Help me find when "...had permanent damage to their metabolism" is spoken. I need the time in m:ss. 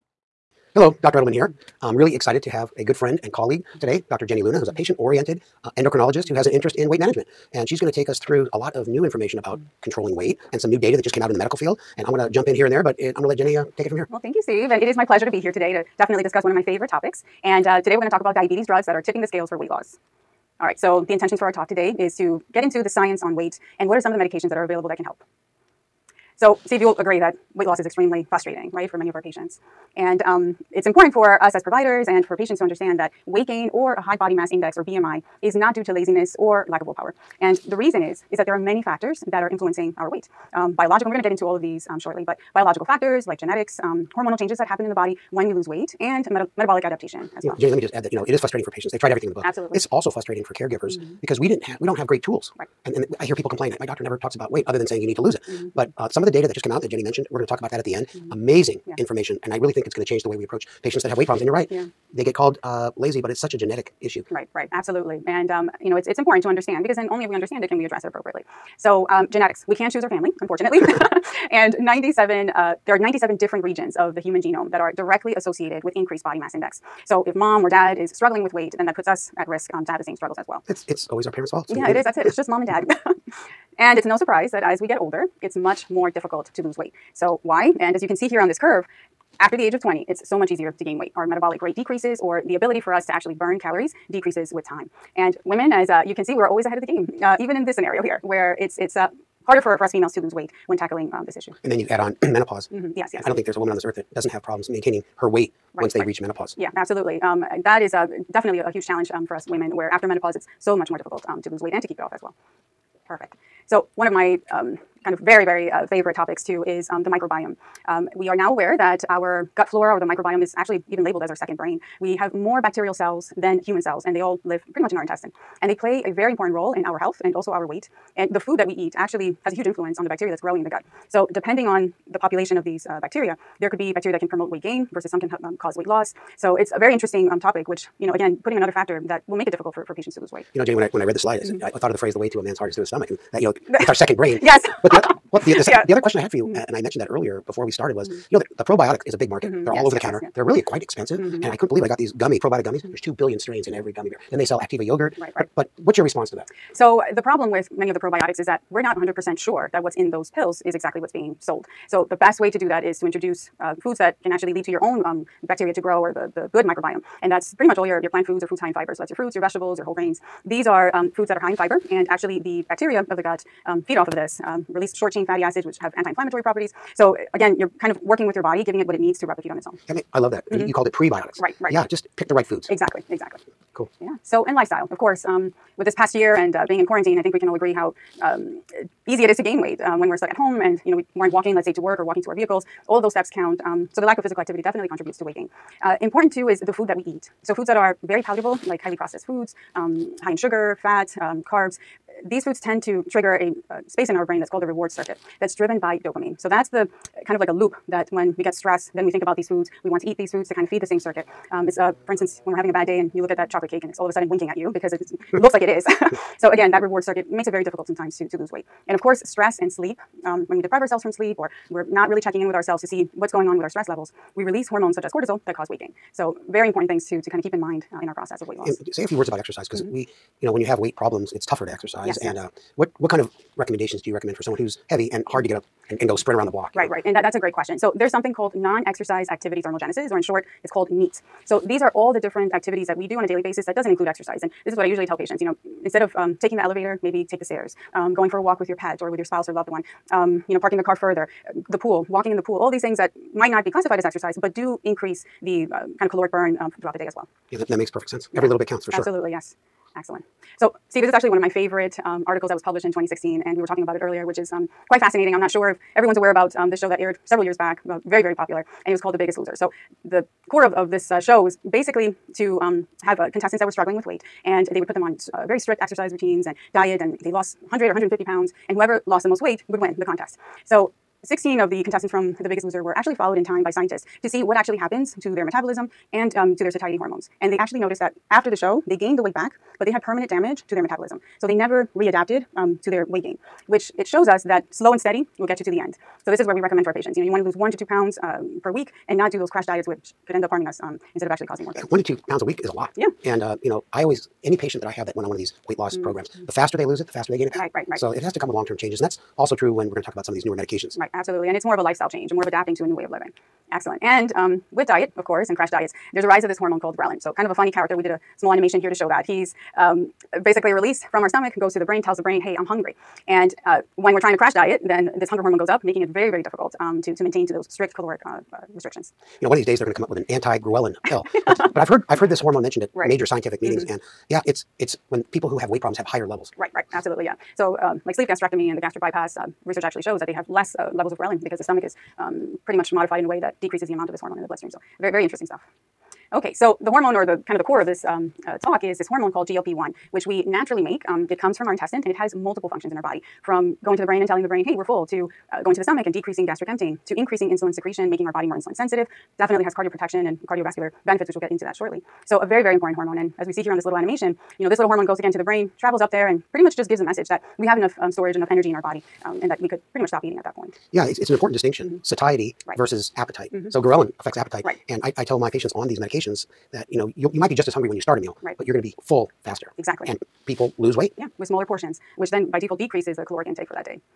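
4:49.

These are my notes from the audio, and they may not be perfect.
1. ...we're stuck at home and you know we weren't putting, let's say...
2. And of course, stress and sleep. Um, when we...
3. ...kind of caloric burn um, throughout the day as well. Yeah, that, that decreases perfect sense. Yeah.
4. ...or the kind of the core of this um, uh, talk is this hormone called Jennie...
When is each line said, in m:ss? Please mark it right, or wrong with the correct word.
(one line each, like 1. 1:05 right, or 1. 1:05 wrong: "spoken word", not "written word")
1. 3:10 wrong: "walking", not "putting"
2. 3:38 right
3. 4:15 wrong: "makes", not "decreases"
4. 5:47 wrong: "GLP", not "Jennie".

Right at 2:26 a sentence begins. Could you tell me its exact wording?
uh, and I mentioned that earlier before we started, was mm.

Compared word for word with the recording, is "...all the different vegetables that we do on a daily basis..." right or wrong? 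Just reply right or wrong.
wrong.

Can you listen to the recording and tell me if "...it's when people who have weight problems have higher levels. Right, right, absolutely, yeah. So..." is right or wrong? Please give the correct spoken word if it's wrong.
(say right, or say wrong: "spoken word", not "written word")
right.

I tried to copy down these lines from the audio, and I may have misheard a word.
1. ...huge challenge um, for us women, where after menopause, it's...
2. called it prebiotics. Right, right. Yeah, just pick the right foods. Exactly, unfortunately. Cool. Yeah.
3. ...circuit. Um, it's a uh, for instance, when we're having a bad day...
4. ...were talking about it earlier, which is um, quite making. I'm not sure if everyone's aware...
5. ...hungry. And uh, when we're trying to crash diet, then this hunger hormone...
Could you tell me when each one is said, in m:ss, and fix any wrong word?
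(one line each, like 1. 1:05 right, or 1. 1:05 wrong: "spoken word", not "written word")
1. 1:48 right
2. 3:00 wrong: "exactly", not "unfortunately"
3. 3:30 right
4. 4:23 wrong: "fascinating", not "making"
5. 5:22 right.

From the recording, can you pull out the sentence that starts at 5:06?
programs, the faster they lose it, the faster they gain it back.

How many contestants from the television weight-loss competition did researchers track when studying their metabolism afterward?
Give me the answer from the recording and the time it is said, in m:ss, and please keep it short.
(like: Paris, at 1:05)
16, at 4:41.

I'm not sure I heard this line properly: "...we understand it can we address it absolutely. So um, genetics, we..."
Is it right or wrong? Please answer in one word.
wrong.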